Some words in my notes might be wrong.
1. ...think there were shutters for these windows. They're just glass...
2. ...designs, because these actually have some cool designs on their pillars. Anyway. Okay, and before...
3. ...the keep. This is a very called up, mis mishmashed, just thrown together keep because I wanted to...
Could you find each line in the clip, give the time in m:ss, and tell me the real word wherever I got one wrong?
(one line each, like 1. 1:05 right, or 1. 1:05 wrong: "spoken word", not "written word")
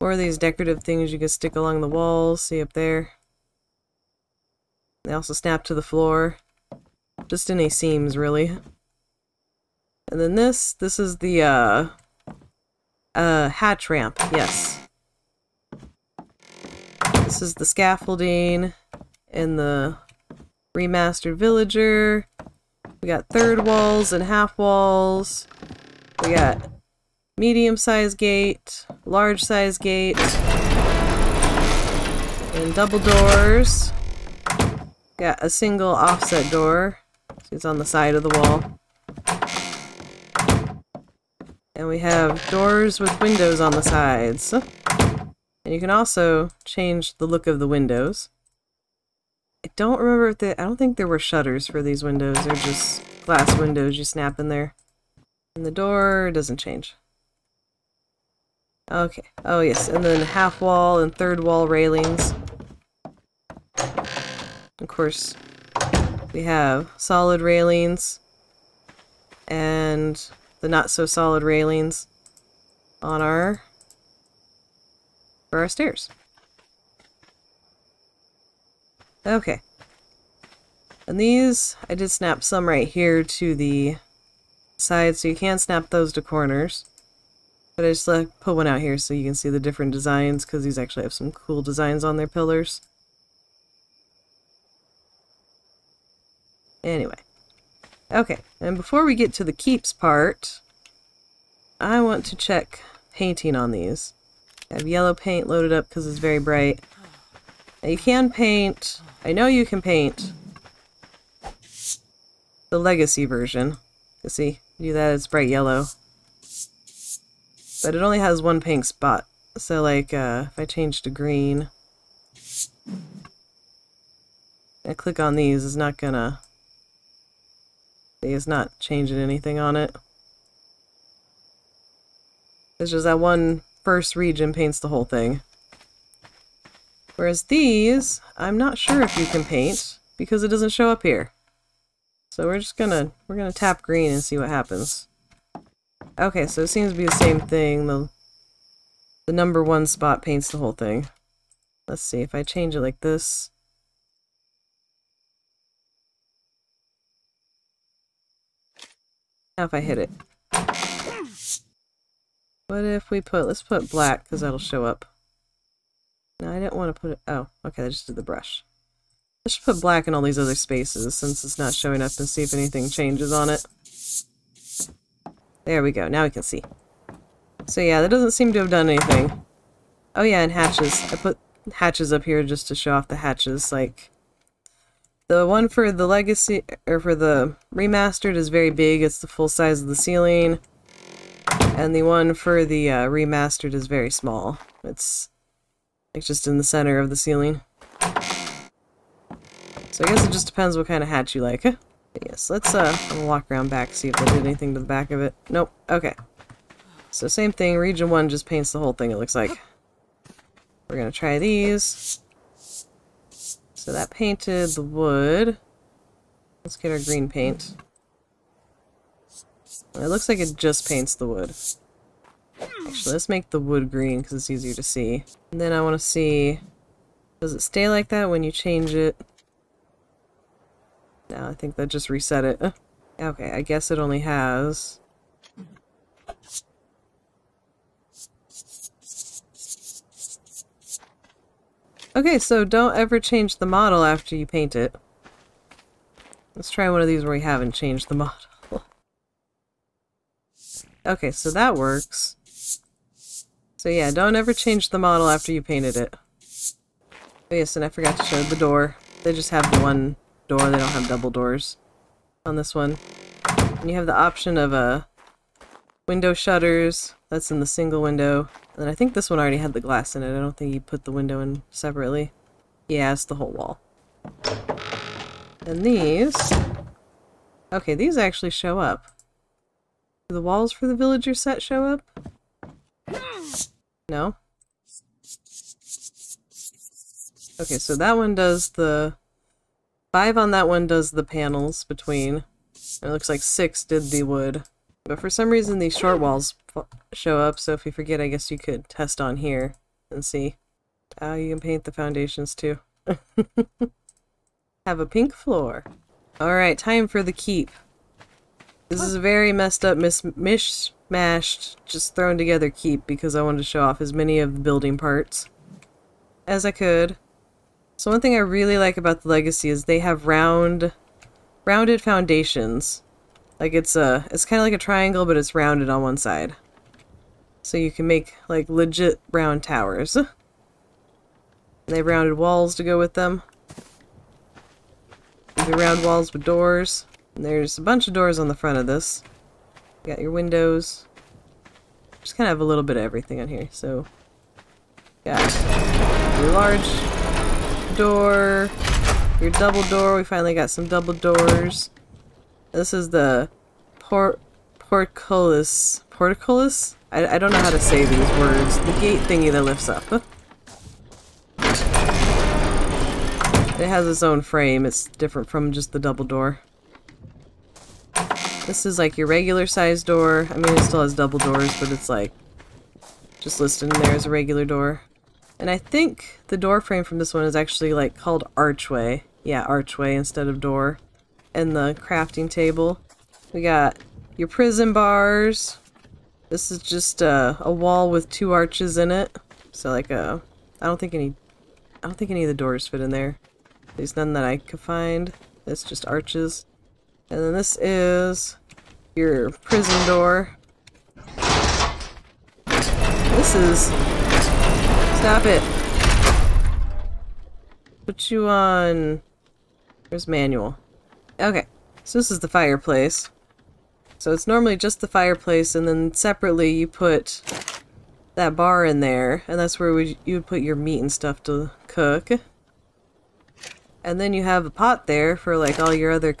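1. 0:50 right
2. 1:29 right
3. 5:07 wrong: "messed", not "called".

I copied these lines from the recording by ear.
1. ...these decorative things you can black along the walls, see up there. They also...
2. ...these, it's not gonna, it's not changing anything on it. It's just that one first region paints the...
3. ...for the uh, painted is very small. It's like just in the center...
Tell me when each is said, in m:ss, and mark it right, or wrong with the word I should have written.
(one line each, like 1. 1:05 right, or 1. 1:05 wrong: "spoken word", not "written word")
1. 0:00 wrong: "stick", not "black"
2. 2:05 right
3. 3:12 wrong: "remastered", not "painted".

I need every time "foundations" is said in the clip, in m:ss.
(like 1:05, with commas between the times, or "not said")
5:01, 5:22.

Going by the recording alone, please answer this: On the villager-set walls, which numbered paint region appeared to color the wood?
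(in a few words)
6.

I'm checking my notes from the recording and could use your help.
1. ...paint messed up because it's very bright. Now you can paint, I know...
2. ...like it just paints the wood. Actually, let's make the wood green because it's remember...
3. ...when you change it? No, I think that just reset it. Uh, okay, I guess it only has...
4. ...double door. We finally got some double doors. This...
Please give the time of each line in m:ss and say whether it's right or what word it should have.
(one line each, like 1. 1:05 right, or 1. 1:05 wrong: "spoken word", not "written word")
1. 1:45 wrong: "loaded", not "messed"
2. 3:40 wrong: "easier", not "remember"
3. 3:48 right
4. 5:49 right.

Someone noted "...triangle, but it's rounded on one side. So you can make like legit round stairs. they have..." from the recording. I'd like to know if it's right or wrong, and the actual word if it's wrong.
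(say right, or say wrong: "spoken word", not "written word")
wrong: "towers", not "stairs".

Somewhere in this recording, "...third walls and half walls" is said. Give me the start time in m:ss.
0:23.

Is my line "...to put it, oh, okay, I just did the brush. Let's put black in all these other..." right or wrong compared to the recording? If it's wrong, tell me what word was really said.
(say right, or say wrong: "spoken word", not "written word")
right.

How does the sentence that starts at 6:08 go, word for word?
This is like your regular size door.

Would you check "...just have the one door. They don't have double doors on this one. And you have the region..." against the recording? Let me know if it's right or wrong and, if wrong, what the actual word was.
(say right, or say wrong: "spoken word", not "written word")
wrong: "option", not "region".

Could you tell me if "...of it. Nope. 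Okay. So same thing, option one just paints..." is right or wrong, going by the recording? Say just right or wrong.
wrong.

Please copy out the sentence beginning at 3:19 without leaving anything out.
So I guess it just depends what kind of hatch you like.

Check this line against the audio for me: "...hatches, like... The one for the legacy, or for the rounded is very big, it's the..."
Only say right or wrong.
wrong.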